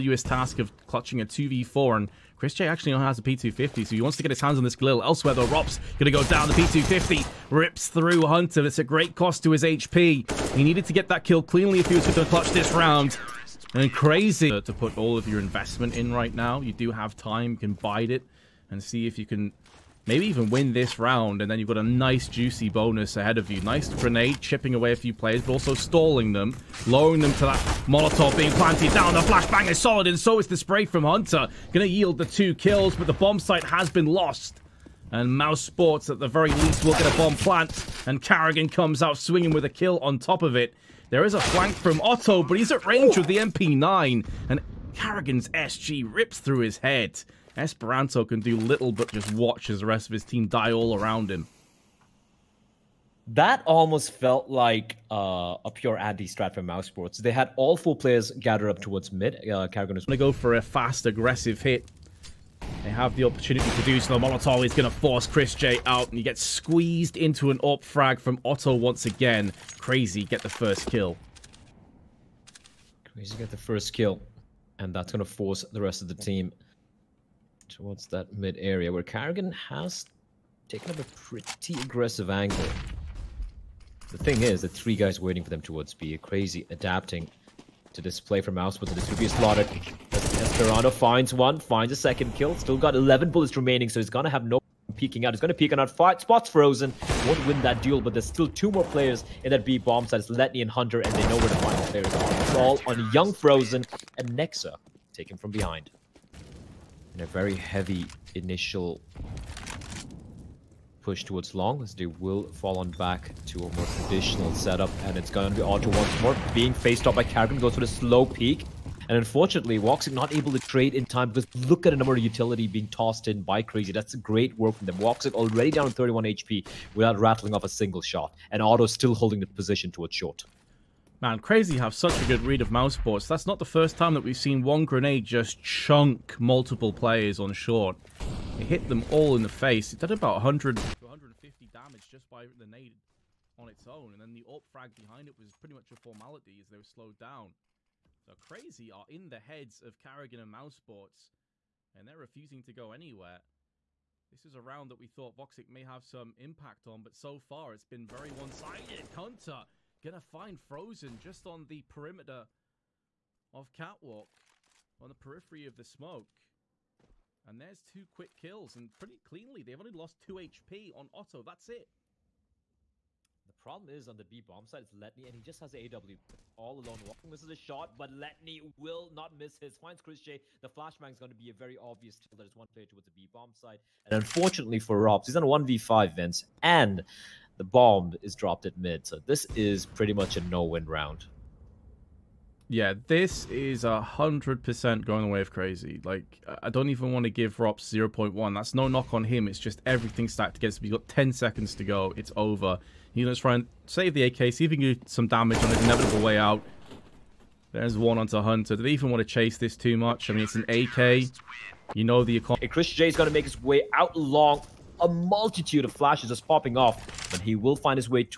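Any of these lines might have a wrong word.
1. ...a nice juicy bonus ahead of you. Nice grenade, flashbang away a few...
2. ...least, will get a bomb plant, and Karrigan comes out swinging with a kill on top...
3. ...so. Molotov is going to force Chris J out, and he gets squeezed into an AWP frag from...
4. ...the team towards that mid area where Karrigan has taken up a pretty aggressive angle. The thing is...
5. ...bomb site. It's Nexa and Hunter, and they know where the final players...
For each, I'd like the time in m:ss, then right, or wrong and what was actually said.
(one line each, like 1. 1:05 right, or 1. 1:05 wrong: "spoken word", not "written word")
1. 0:21 wrong: "chipping", not "flashbang"
2. 0:36 right
3. 1:04 right
4. 1:16 right
5. 1:39 wrong: "Letney", not "Nexa".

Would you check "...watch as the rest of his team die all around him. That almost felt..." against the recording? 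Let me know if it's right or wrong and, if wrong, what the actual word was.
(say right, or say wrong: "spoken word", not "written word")
right.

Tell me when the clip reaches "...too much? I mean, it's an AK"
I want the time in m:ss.
3:29.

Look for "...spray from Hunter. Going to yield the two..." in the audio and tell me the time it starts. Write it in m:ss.
0:30.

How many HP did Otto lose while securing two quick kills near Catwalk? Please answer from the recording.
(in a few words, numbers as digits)
2.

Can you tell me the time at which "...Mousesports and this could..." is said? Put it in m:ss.
1:28.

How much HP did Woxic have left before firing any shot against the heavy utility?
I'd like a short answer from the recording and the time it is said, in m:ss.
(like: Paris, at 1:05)
31, at 2:05.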